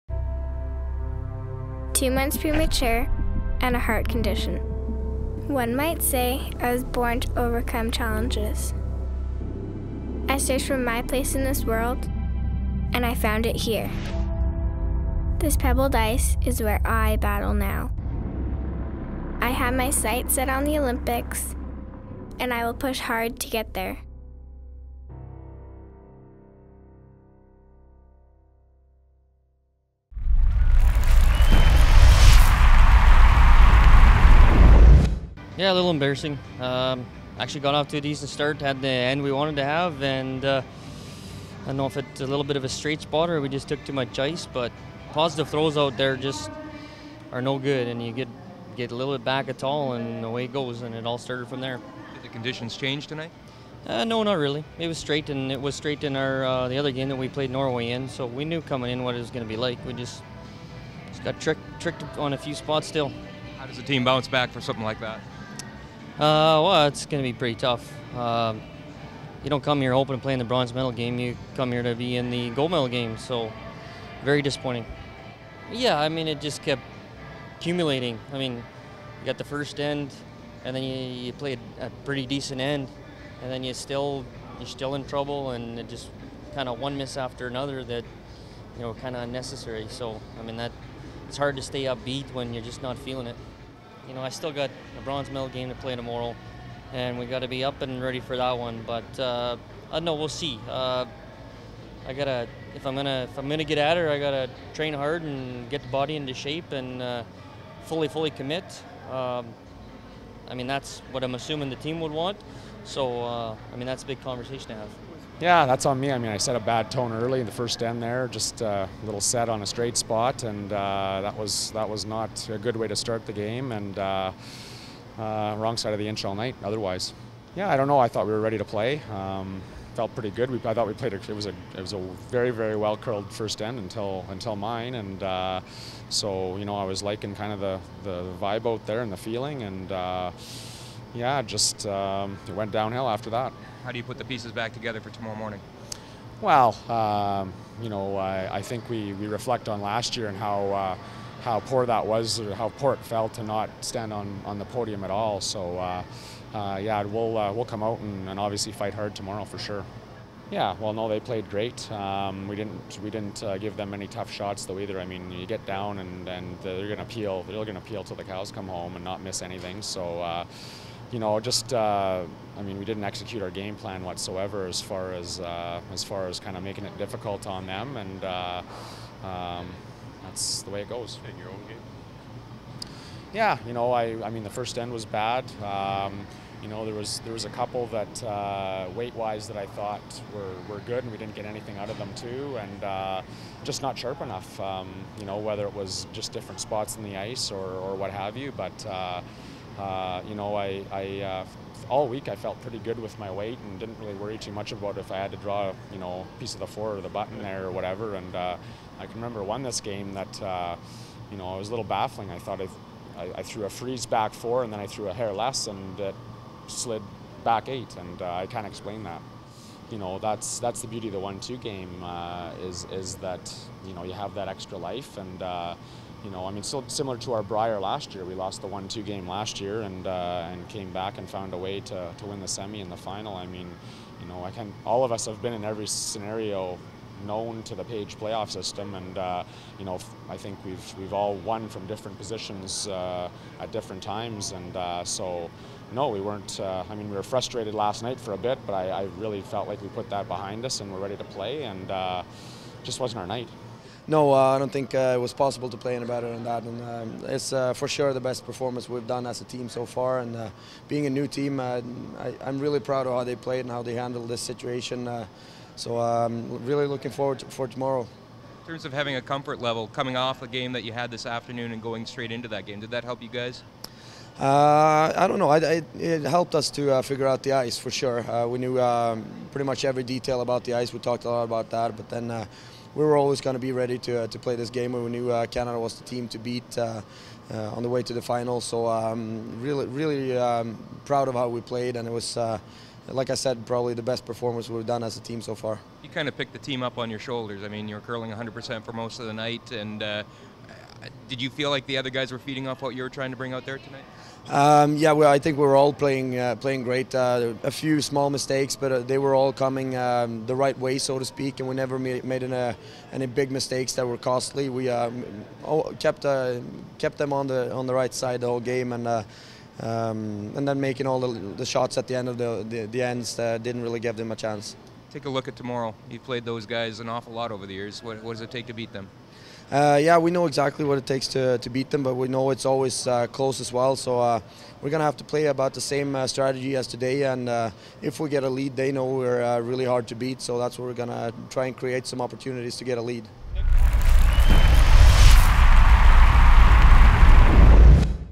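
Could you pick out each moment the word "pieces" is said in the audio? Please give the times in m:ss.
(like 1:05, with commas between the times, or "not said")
2:24, 3:26.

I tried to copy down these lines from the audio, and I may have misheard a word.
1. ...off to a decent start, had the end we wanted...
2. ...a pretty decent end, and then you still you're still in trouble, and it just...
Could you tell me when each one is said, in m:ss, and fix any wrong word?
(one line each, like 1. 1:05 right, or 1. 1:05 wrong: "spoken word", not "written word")
1. 0:37 right
2. 1:21 right.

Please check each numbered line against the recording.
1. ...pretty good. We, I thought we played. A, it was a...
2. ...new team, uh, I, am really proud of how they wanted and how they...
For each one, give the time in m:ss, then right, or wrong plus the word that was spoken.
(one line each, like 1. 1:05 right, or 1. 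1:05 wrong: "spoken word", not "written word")
1. 2:10 right
2. 4:21 wrong: "played", not "wanted".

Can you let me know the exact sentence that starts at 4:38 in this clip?
Uh, we knew um, pretty much every detail about the ice.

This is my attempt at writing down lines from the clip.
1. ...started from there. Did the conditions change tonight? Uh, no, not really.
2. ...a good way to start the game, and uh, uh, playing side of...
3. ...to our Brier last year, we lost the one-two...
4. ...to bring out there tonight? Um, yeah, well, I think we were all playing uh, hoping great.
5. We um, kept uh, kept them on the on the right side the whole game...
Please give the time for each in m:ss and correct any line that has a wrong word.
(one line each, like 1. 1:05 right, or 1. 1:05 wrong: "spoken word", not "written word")
1. 0:51 right
2. 2:02 wrong: "wrong", not "playing"
3. 3:47 right
4. 5:03 wrong: "playing", not "hoping"
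5. 5:14 right.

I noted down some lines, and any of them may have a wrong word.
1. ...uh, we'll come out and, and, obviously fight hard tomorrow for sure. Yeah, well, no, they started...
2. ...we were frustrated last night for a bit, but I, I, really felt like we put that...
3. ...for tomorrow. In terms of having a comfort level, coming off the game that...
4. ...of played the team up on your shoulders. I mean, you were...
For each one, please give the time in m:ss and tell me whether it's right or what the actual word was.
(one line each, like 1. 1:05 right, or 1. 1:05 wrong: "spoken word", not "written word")
1. 2:37 wrong: "played", not "started"
2. 4:07 right
3. 4:27 right
4. 4:56 wrong: "picked", not "played".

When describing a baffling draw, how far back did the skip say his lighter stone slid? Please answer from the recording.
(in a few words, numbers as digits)
eight.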